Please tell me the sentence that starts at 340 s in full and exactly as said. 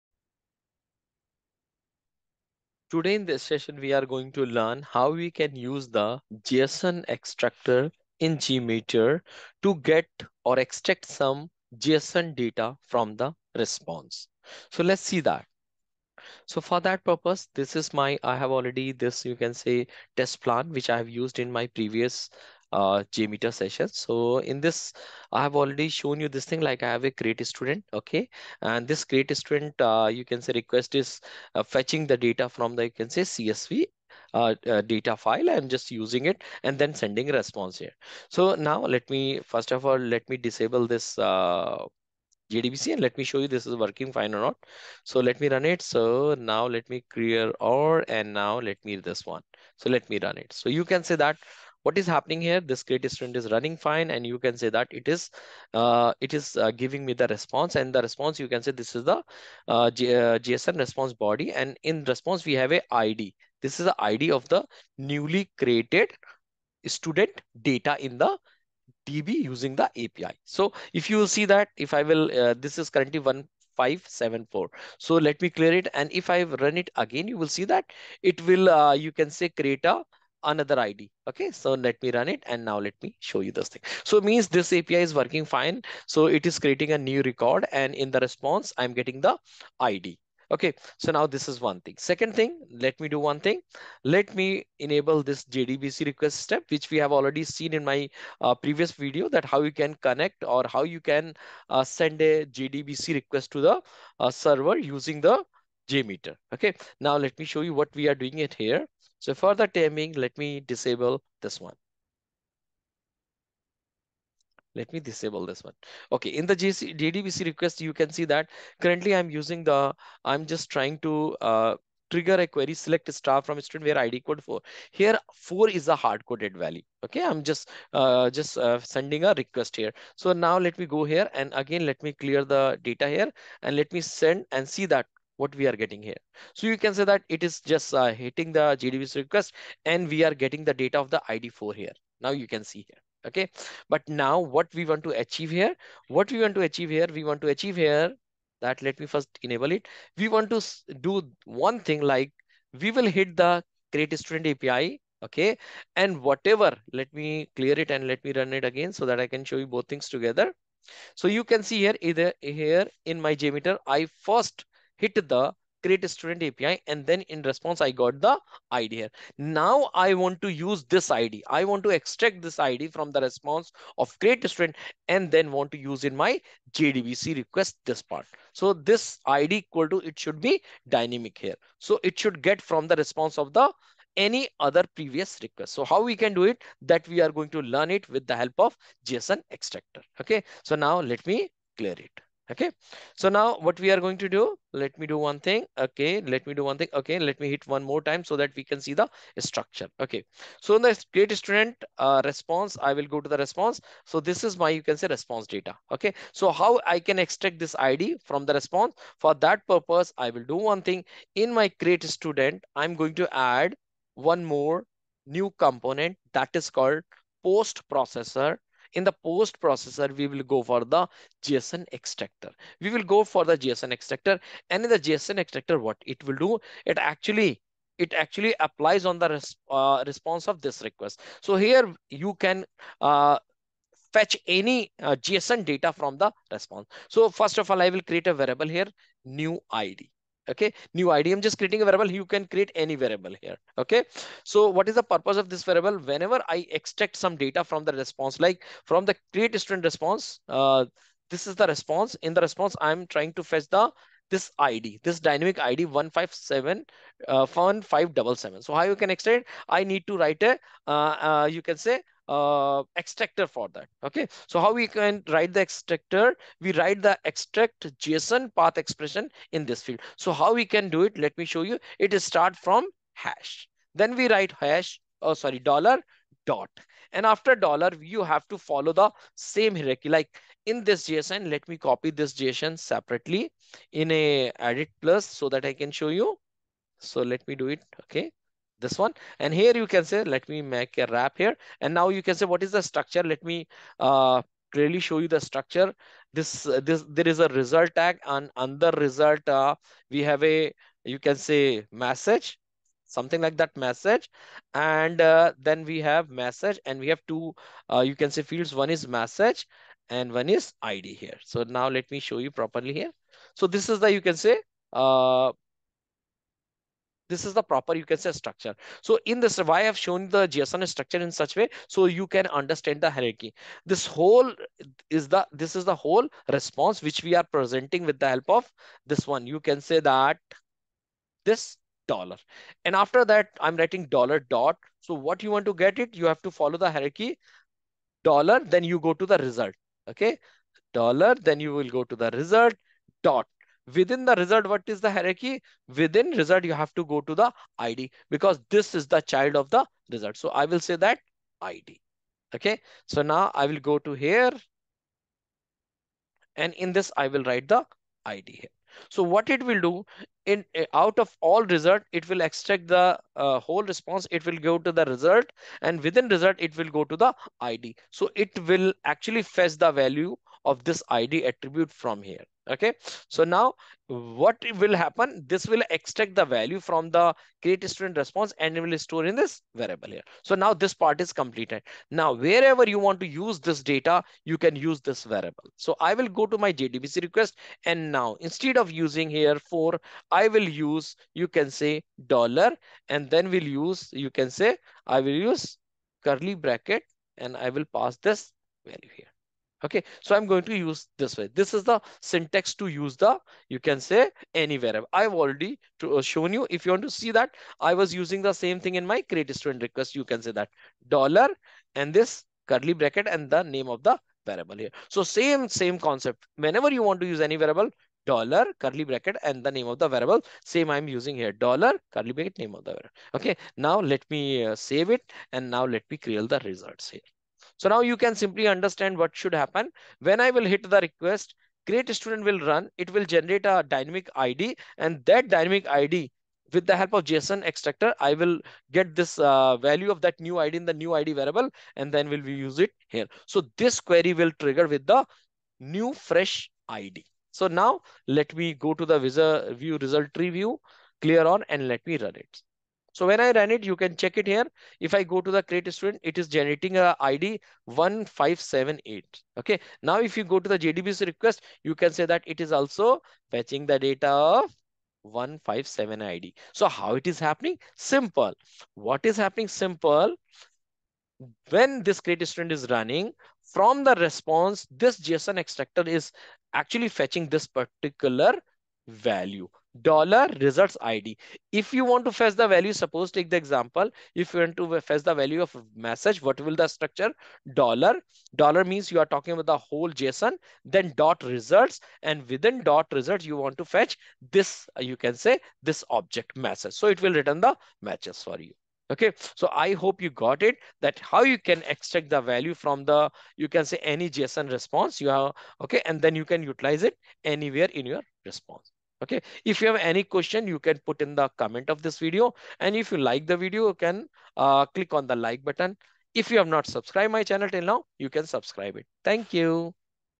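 Okay, dollar, then you will go to the result dot.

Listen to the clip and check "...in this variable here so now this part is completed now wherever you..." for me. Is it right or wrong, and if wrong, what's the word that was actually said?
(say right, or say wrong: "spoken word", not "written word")
right.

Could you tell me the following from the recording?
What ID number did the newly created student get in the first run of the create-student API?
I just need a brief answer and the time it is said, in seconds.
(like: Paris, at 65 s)
1574, at 73 s.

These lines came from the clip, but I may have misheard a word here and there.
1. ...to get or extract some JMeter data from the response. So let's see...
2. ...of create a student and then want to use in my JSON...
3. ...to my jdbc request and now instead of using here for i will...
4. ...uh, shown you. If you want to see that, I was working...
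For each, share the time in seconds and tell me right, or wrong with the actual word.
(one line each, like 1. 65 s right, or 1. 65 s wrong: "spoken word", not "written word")
1. 9 s wrong: "JSON", not "JMeter"
2. 173 s wrong: "JDBC", not "JSON"
3. 386 s right
4. 406 s wrong: "using", not "working".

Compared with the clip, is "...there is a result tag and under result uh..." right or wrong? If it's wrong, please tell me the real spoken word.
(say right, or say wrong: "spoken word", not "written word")
right.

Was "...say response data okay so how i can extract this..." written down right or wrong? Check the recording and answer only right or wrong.
right.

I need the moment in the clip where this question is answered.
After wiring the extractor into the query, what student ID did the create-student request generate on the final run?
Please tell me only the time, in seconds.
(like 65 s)
457 s.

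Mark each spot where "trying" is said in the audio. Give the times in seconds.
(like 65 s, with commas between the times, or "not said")
120 s, 253 s.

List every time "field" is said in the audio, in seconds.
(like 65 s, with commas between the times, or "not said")
269 s, 308 s.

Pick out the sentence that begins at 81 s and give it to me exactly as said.
Okay, so let me run it and now let me show you this thing.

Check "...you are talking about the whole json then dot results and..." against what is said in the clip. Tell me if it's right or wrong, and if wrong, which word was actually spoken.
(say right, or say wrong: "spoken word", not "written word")
right.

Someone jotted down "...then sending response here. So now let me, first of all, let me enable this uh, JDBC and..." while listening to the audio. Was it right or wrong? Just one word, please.
wrong.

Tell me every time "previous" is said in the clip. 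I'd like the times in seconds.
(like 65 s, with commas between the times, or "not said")
21 s, 98 s, 184 s.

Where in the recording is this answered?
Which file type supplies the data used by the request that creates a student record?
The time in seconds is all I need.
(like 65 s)
33 s.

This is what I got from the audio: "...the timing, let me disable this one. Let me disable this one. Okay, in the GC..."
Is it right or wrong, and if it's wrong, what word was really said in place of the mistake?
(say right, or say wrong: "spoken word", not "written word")
right.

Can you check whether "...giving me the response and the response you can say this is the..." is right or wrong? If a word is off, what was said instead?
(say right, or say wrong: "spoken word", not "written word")
right.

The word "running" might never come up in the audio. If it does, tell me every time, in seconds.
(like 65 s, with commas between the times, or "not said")
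53 s, 472 s.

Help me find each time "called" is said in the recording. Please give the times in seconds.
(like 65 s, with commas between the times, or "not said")
216 s.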